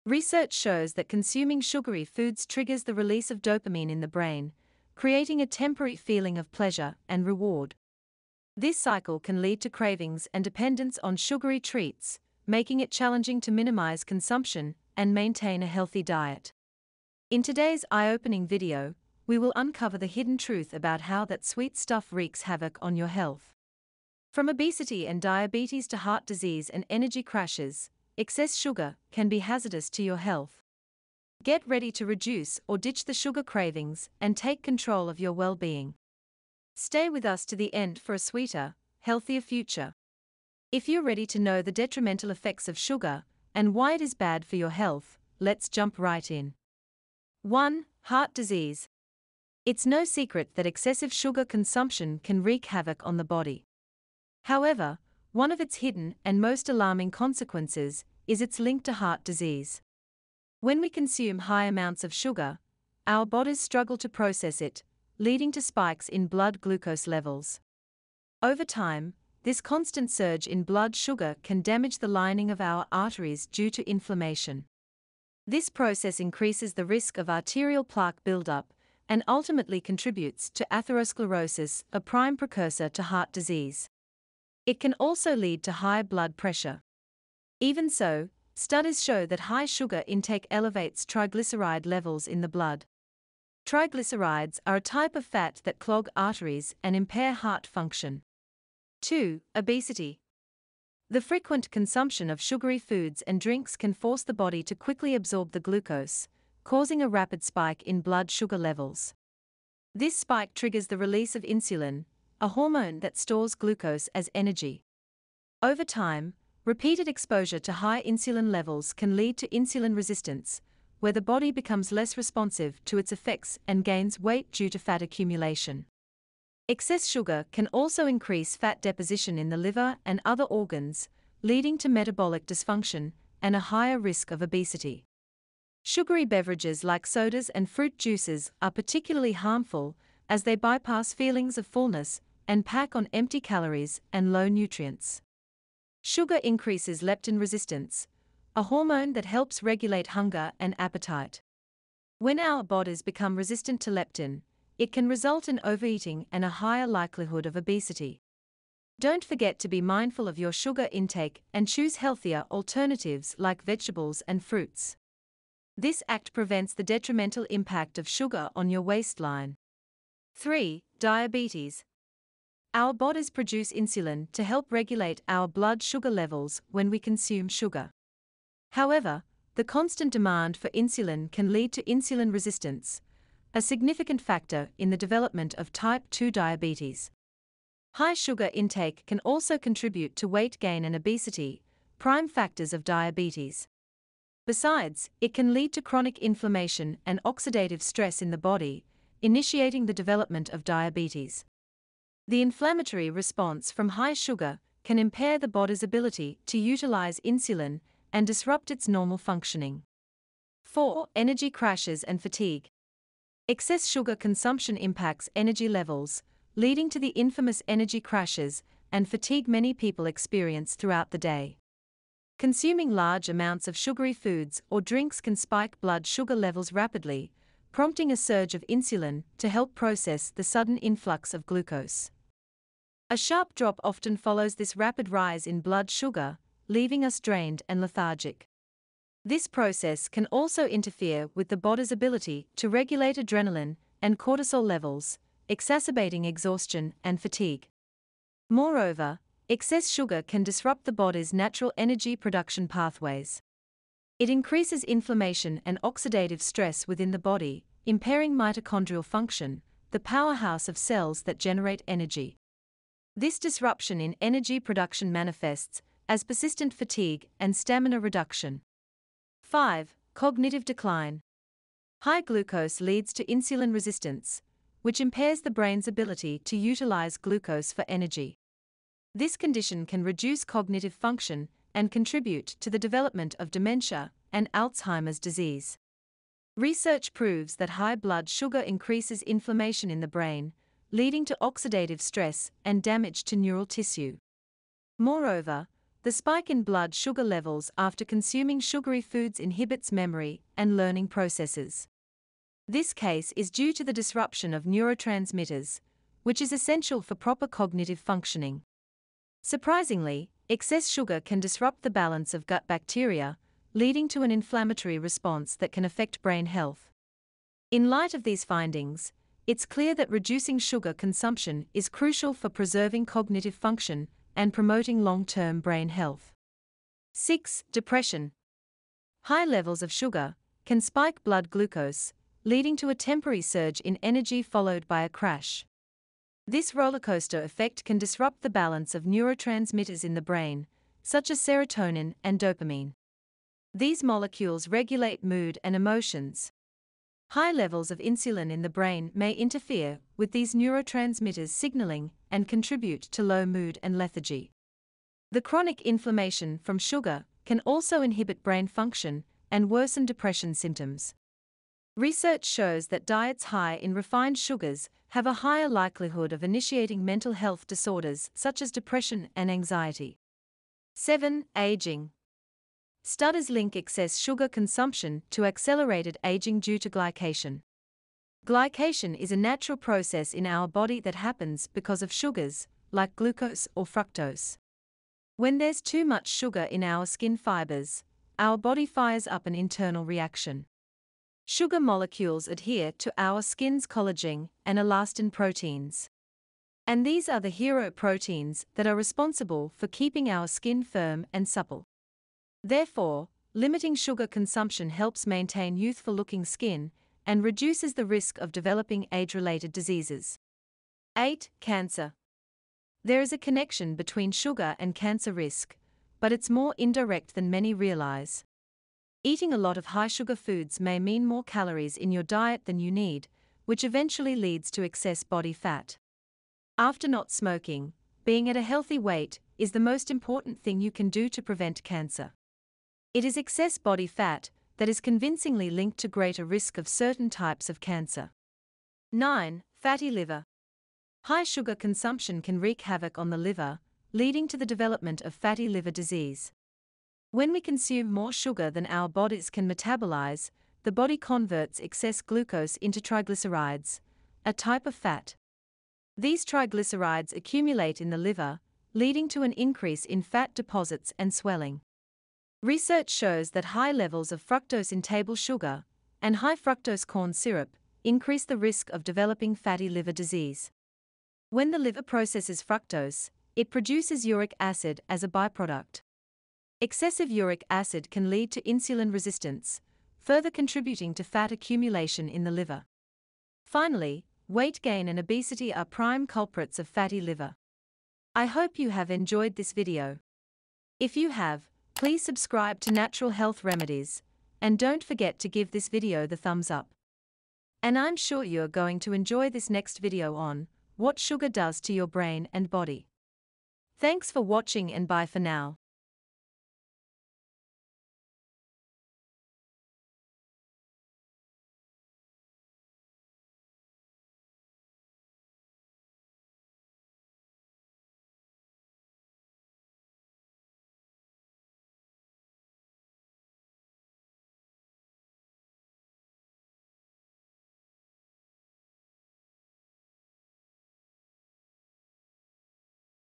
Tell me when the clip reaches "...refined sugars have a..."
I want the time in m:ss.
6:03.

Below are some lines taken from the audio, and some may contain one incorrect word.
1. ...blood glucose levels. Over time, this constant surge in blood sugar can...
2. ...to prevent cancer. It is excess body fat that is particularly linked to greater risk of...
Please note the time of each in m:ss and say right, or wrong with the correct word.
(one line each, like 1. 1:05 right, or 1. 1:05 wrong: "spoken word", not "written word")
1. 1:06 right
2. 7:11 wrong: "convincingly", not "particularly".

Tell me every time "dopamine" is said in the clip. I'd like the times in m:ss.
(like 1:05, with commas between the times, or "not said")
0:03, 5:42.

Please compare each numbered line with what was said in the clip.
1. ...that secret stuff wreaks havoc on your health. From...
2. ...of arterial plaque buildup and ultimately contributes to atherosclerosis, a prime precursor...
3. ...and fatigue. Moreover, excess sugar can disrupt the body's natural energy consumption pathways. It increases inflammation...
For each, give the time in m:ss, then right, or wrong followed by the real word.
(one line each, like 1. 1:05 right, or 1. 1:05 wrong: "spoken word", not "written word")
1. 0:21 wrong: "sweet", not "secret"
2. 1:17 right
3. 4:07 wrong: "production", not "consumption".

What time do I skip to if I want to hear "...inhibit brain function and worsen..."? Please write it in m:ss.
5:58.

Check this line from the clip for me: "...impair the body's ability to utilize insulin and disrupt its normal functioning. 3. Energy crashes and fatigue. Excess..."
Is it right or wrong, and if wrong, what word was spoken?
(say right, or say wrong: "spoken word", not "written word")
wrong: "4", not "3".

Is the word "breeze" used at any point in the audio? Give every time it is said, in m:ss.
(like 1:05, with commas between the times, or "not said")
not said.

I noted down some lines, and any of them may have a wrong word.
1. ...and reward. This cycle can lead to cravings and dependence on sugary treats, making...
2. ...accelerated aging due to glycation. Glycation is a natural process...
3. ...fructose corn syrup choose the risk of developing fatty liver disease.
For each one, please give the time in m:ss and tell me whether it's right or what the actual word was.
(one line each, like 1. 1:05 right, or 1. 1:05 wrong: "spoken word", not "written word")
1. 0:07 right
2. 6:15 right
3. 7:46 wrong: "increase", not "choose".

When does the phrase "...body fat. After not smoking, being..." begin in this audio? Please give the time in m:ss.
7:05.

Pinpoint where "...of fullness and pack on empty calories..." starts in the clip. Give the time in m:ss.
2:21.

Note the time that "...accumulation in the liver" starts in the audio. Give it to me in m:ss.
8:01.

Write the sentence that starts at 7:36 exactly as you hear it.
These triglycerides accumulate in the liver, leading to an increase in fat deposits and swelling.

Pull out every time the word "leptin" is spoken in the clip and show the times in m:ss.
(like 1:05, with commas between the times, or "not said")
2:27, 2:33.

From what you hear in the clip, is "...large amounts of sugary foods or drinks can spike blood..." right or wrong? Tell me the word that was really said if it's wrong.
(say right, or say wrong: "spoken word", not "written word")
right.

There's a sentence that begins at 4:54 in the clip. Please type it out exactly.
Moreover, the spike in blood sugar levels after consuming sugary foods inhibits memory and learning processes.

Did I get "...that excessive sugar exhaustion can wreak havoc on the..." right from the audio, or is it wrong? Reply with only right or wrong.
wrong.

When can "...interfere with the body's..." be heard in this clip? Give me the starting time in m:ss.
4:00.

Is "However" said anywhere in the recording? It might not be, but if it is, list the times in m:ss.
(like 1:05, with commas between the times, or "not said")
0:54, 2:58.